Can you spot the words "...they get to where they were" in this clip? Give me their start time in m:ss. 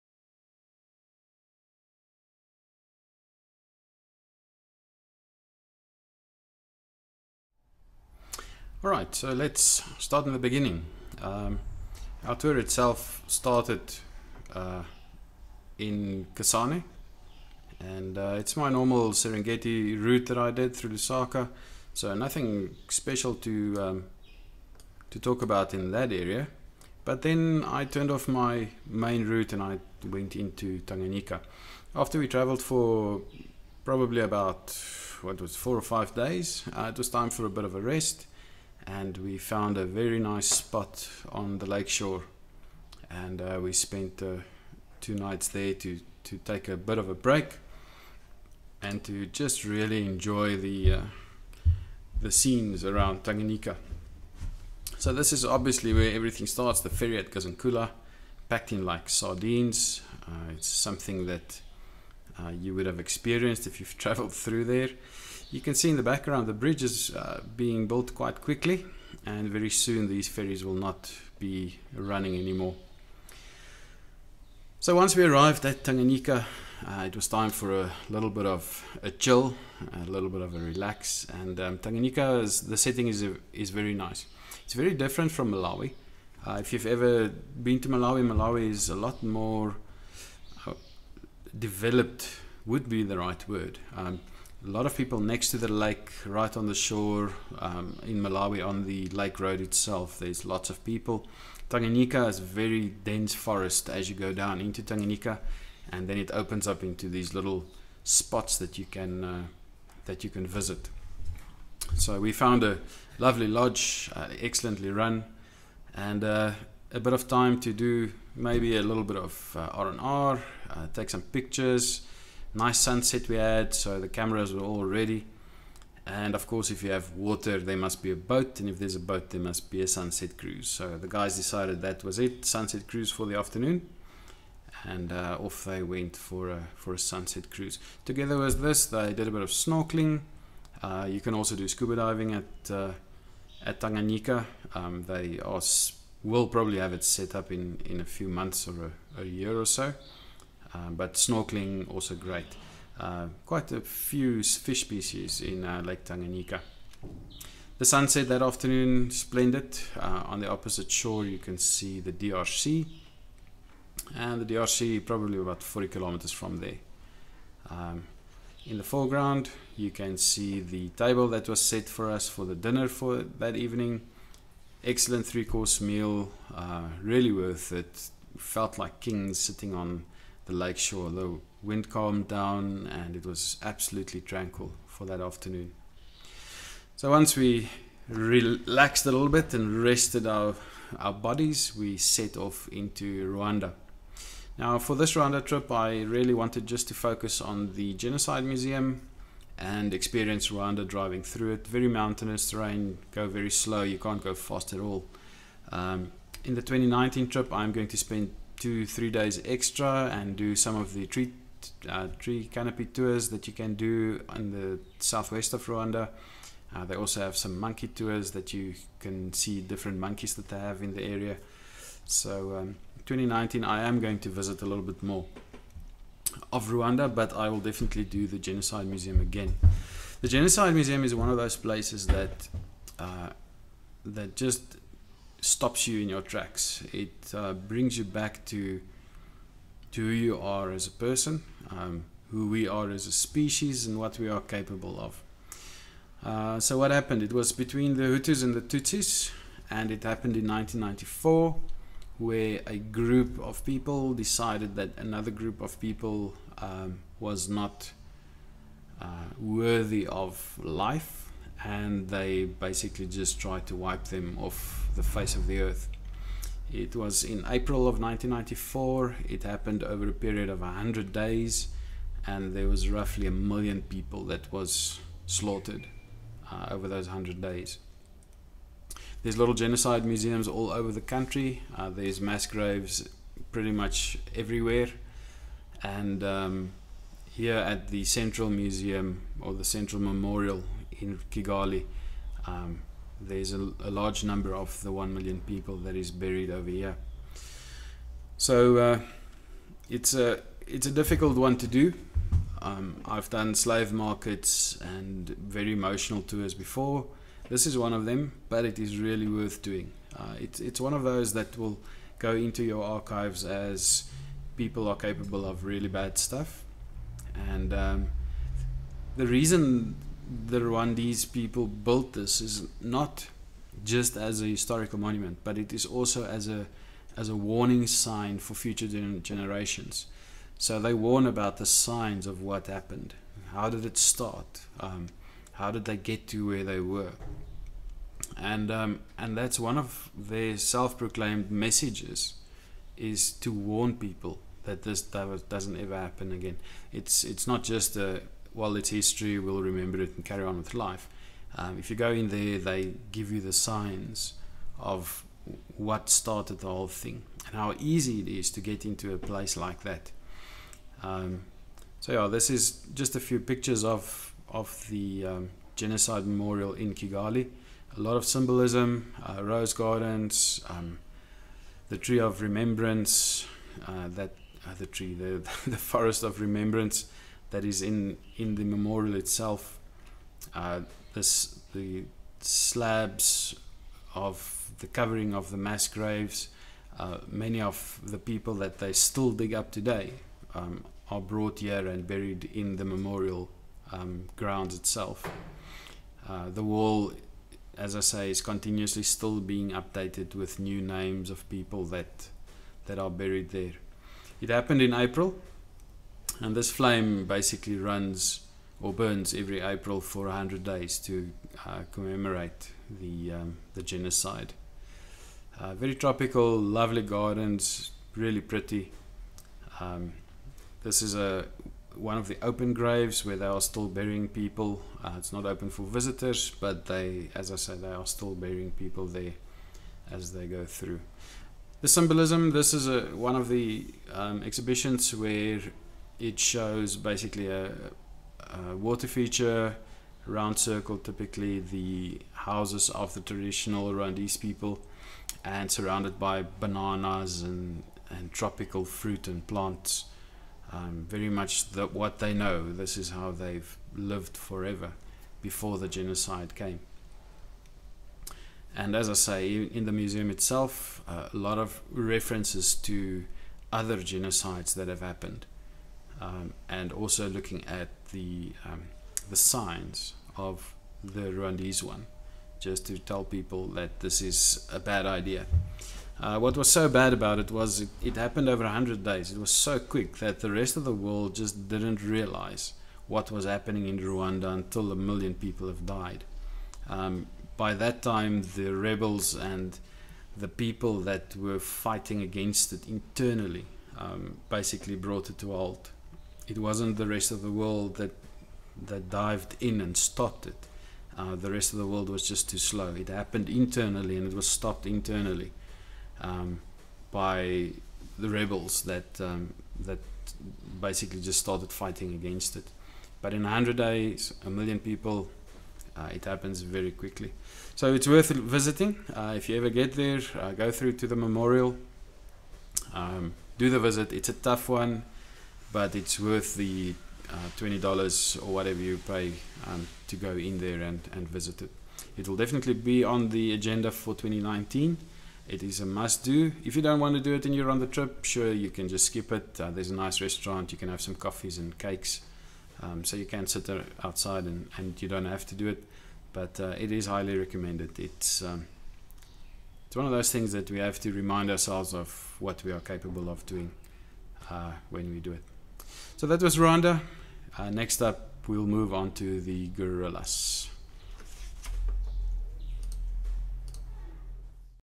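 5:35.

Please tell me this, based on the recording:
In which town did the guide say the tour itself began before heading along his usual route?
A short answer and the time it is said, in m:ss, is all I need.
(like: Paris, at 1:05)
Kasane, at 0:16.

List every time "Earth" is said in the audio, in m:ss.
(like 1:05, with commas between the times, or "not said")
4:25.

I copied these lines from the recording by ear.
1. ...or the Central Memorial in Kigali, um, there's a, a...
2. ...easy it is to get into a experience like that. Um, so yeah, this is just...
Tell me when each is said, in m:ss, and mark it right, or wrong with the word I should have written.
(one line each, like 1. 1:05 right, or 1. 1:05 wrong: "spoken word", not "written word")
1. 4:49 right
2. 5:57 wrong: "place", not "experience".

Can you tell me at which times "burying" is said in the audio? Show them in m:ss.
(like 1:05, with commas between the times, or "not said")
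7:03, 7:08.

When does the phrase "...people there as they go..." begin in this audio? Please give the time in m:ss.
7:08.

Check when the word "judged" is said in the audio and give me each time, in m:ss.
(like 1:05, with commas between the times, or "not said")
not said.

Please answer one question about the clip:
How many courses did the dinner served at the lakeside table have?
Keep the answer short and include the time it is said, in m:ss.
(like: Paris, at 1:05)
3, at 2:55.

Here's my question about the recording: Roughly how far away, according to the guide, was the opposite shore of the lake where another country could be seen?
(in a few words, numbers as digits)
40 kilometers.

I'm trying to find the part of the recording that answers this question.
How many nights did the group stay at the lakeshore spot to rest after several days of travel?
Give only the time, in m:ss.
0:44.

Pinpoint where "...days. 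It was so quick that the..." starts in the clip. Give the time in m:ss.
7:59.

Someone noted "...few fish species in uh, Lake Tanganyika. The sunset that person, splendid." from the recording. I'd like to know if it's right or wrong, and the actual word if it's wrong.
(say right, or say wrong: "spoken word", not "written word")
wrong: "afternoon", not "person".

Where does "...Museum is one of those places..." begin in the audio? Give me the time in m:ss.
3:50.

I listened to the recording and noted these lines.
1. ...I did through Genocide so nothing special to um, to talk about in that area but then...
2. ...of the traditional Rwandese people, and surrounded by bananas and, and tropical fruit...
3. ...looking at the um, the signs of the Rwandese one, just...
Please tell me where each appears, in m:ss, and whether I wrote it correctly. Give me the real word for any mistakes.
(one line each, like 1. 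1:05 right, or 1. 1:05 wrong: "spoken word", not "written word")
1. 0:20 wrong: "Lusaka", not "Genocide"
2. 7:22 right
3. 7:47 right.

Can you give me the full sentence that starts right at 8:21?
Uh, the rest of the world was just too slow.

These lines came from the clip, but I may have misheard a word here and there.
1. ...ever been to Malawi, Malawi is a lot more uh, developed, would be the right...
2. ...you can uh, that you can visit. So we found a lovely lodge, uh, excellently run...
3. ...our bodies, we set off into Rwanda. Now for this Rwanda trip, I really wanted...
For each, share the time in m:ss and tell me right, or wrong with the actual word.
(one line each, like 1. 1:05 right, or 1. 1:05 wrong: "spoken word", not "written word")
1. 1:26 right
2. 1:48 right
3. 3:10 right.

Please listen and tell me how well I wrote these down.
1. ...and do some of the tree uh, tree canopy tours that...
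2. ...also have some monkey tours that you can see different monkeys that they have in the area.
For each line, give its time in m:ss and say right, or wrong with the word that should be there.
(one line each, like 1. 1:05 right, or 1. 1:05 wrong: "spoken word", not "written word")
1. 3:30 right
2. 3:36 right.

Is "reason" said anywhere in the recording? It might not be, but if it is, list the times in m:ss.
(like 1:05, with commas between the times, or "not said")
5:19.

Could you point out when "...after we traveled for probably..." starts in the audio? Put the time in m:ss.
0:31.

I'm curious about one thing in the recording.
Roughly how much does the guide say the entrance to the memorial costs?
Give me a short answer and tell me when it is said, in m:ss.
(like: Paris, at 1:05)
$20, at 8:47.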